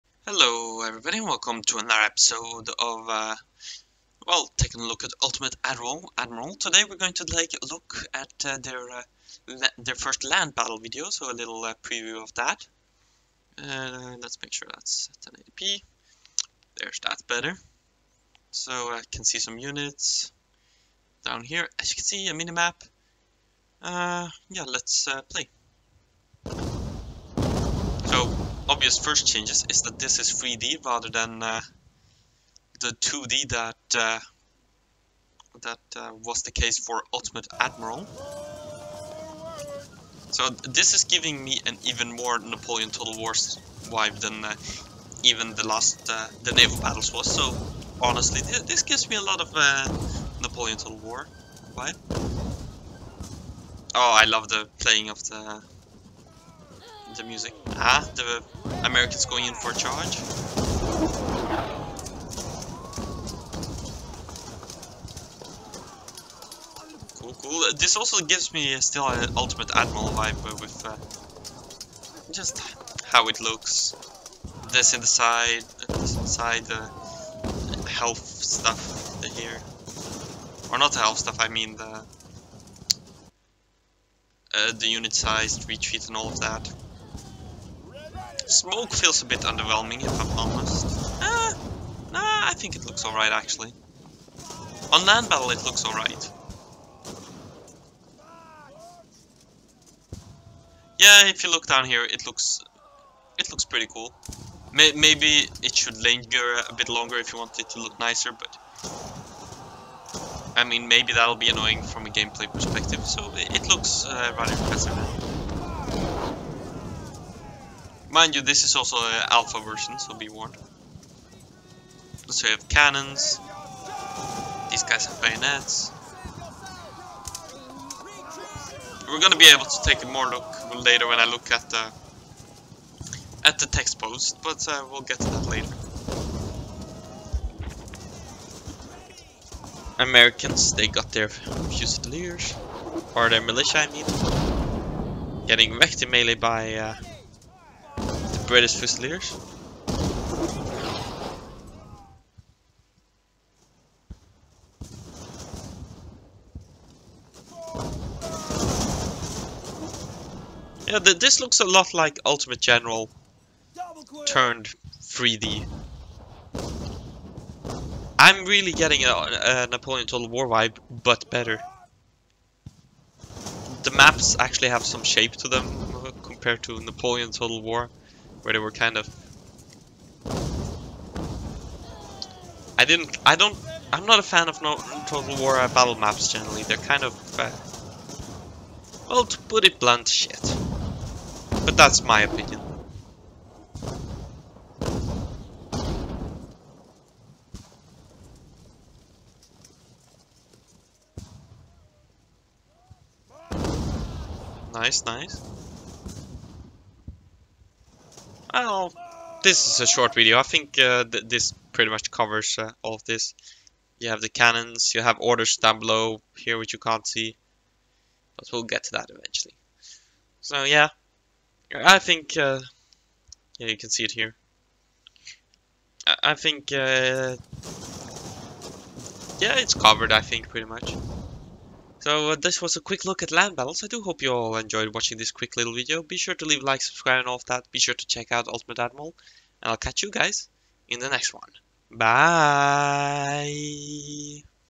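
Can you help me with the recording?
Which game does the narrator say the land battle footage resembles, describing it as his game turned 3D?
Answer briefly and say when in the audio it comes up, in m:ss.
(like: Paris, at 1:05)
Ultimate General, at 2:42.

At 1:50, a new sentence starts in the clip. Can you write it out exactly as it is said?
I mean, maybe that'll be annoying from a gameplay perspective, so it looks uh, rather impressive.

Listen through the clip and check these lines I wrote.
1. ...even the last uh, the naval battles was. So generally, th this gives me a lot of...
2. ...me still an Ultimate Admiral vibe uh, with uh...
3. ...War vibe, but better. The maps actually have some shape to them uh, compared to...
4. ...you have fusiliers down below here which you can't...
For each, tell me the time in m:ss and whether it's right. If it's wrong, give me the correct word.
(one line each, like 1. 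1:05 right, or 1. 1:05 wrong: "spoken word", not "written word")
1. 0:45 wrong: "honestly", not "generally"
2. 1:08 right
3. 2:50 right
4. 3:34 wrong: "orders", not "fusiliers".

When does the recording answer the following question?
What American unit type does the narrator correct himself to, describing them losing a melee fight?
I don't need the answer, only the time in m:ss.
2:23.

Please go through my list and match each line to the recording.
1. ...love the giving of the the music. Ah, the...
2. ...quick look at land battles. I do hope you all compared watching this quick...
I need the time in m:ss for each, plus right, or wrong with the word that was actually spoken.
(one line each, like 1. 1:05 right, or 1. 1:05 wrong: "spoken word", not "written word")
1. 0:54 wrong: "playing", not "giving"
2. 3:52 wrong: "enjoyed", not "compared".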